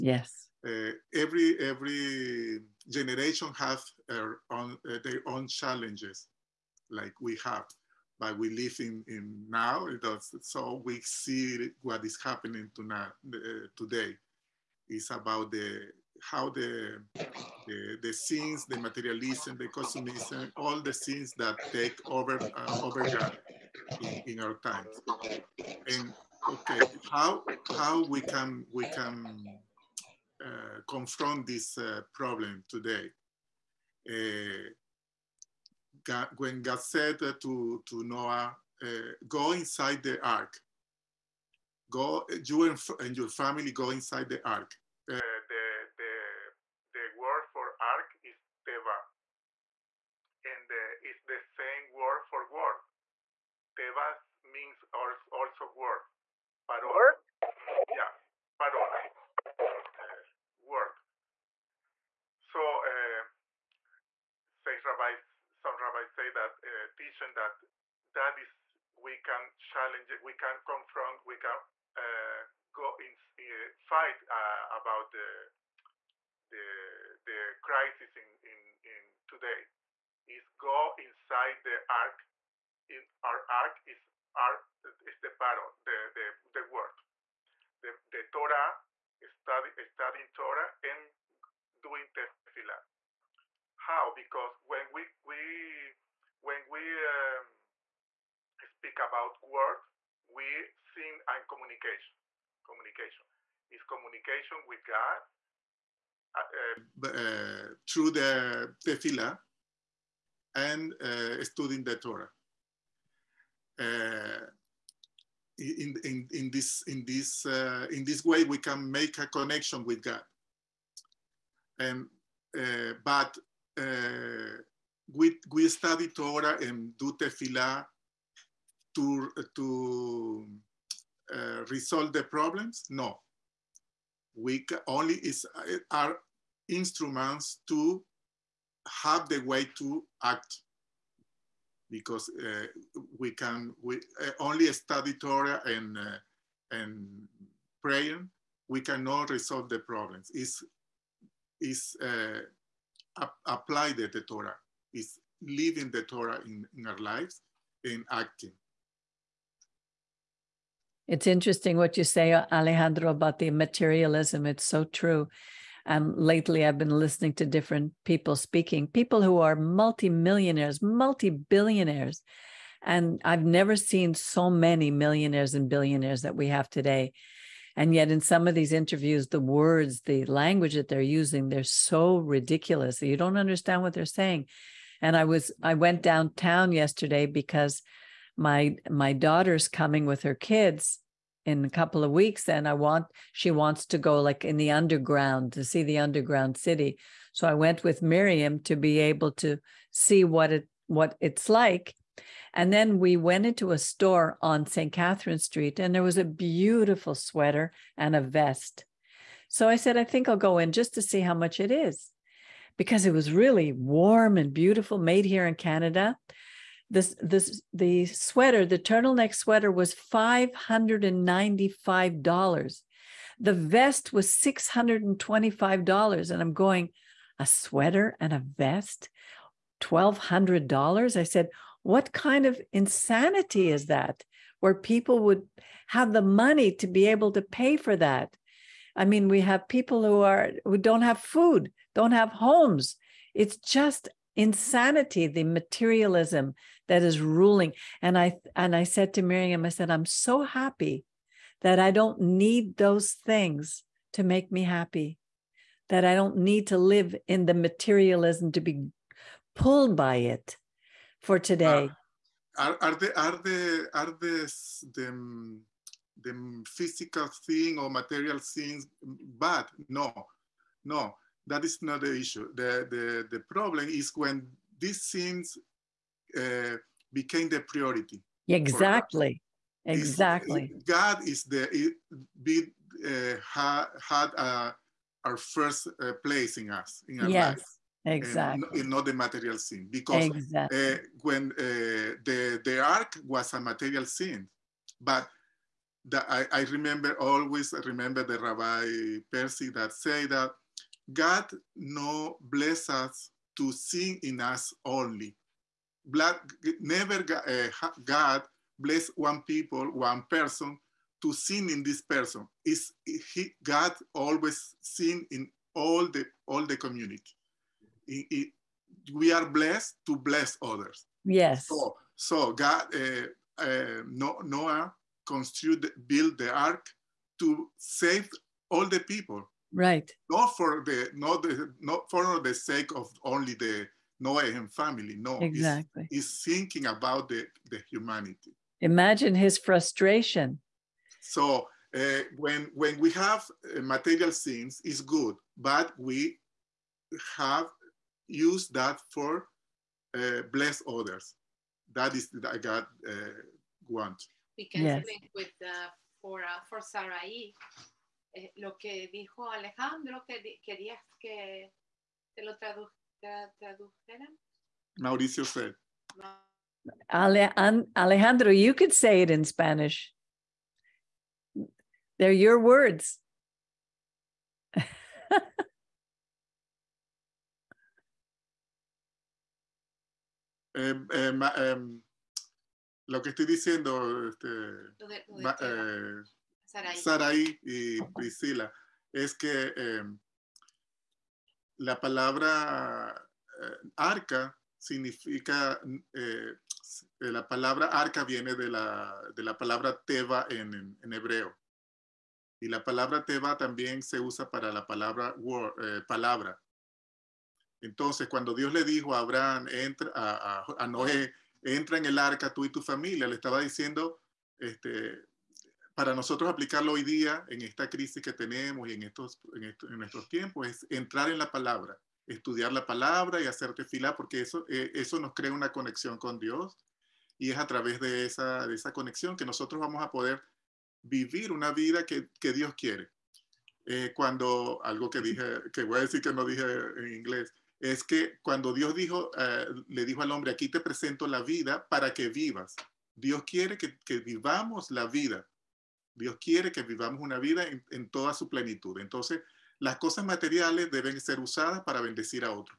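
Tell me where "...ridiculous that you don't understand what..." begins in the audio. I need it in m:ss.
3:02.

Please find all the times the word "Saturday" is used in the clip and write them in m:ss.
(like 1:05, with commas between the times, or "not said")
not said.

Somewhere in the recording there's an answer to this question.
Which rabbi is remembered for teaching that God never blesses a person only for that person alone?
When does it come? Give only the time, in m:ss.
4:58.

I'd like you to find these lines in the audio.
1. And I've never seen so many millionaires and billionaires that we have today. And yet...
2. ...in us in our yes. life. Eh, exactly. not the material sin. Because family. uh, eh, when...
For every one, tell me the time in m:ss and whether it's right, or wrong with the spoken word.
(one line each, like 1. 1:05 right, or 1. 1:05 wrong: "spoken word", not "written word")
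1. 2:52 right
2. 4:46 wrong: "exactly", not "family".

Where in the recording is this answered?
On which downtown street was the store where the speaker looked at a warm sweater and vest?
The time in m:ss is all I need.
3:24.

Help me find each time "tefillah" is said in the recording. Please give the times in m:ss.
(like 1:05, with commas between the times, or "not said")
1:32, 1:48, 2:07.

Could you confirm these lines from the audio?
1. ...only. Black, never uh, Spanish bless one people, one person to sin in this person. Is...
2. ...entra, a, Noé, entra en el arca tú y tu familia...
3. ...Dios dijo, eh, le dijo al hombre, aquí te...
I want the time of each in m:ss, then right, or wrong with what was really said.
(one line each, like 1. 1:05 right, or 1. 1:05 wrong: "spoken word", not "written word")
1. 5:04 wrong: "God", not "Spanish"
2. 6:49 right
3. 7:18 right.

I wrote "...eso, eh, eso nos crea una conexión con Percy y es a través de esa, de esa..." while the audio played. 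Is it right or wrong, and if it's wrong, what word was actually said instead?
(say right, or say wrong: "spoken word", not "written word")
wrong: "Dios", not "Percy".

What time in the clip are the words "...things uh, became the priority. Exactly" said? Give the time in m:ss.
4:35.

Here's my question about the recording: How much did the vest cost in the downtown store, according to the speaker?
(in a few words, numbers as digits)
$625.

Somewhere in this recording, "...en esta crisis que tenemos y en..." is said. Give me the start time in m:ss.
6:57.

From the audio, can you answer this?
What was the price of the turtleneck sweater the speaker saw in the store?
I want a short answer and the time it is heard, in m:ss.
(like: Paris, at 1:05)
$595, at 3:39.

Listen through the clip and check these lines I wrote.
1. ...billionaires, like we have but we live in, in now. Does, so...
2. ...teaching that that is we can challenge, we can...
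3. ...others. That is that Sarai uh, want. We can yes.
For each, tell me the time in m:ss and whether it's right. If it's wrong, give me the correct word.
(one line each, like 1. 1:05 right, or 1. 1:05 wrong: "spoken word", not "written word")
1. 0:05 wrong: "challenges", not "billionaires"
2. 1:06 right
3. 5:50 wrong: "God", not "Sarai".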